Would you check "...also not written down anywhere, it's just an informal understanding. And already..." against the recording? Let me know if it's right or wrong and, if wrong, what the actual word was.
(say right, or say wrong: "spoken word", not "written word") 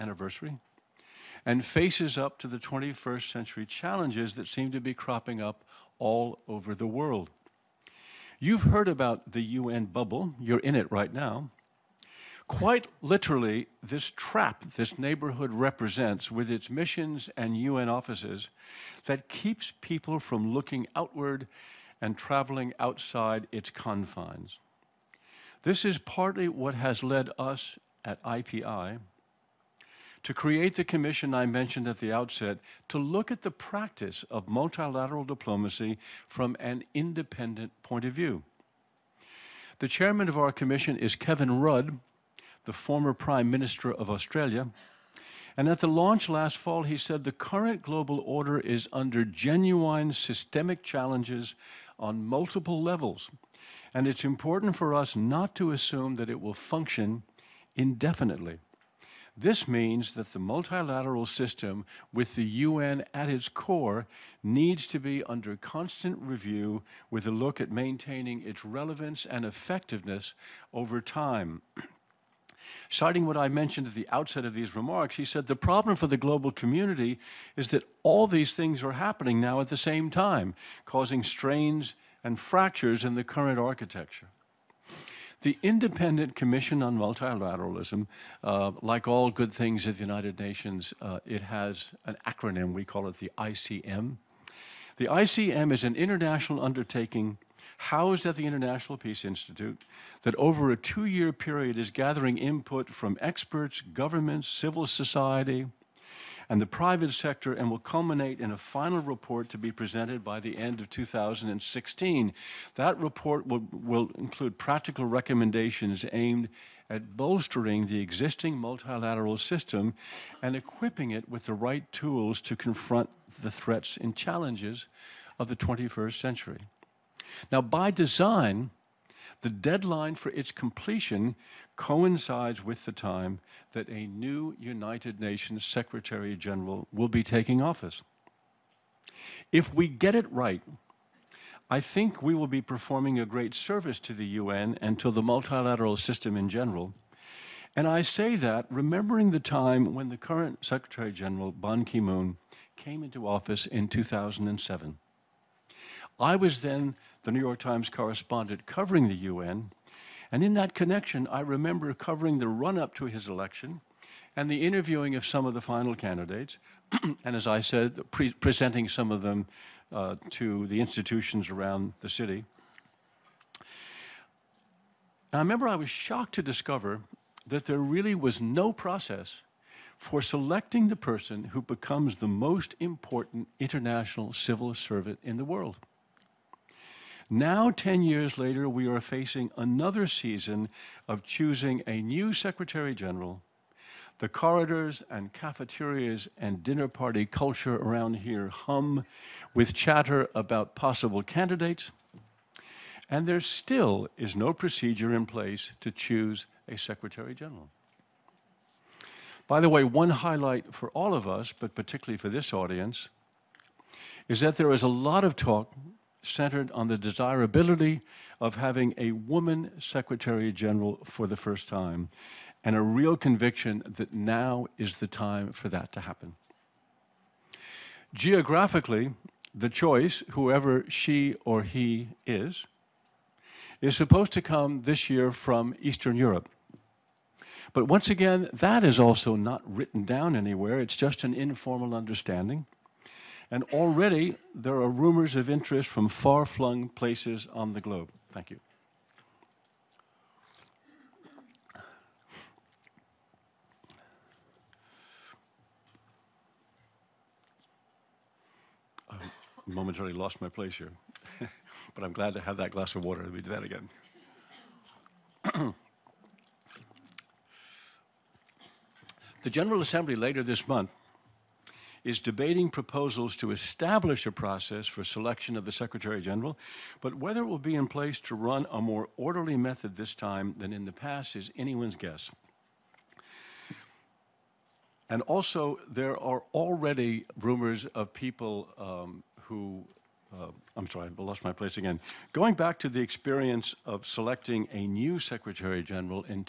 right.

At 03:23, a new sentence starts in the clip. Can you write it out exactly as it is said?
And there still is no procedure in place to choose a Secretary General.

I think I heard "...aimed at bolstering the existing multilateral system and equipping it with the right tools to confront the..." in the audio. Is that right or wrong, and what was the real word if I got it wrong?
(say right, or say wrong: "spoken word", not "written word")
right.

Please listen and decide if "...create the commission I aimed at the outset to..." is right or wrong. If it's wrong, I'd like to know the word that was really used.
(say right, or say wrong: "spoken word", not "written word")
wrong: "mentioned", not "aimed".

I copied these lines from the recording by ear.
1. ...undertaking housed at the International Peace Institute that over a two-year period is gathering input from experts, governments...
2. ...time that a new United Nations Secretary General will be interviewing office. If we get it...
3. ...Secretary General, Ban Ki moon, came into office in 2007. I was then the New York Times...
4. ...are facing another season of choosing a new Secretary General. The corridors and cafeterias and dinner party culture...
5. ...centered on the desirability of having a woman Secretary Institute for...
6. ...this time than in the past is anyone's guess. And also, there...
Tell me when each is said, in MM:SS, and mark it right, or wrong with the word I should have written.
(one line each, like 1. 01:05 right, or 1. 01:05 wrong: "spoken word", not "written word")
1. 01:36 right
2. 02:12 wrong: "taking", not "interviewing"
3. 02:30 right
4. 03:08 right
5. 03:36 wrong: "General", not "Institute"
6. 04:39 right.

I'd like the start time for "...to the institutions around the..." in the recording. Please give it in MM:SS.
02:50.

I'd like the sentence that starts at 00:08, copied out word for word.
You've heard about the UN bubble, you're in it right now.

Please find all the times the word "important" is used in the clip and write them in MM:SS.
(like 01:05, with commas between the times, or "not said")
00:54, 03:02.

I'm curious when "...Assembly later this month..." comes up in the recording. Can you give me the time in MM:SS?
04:29.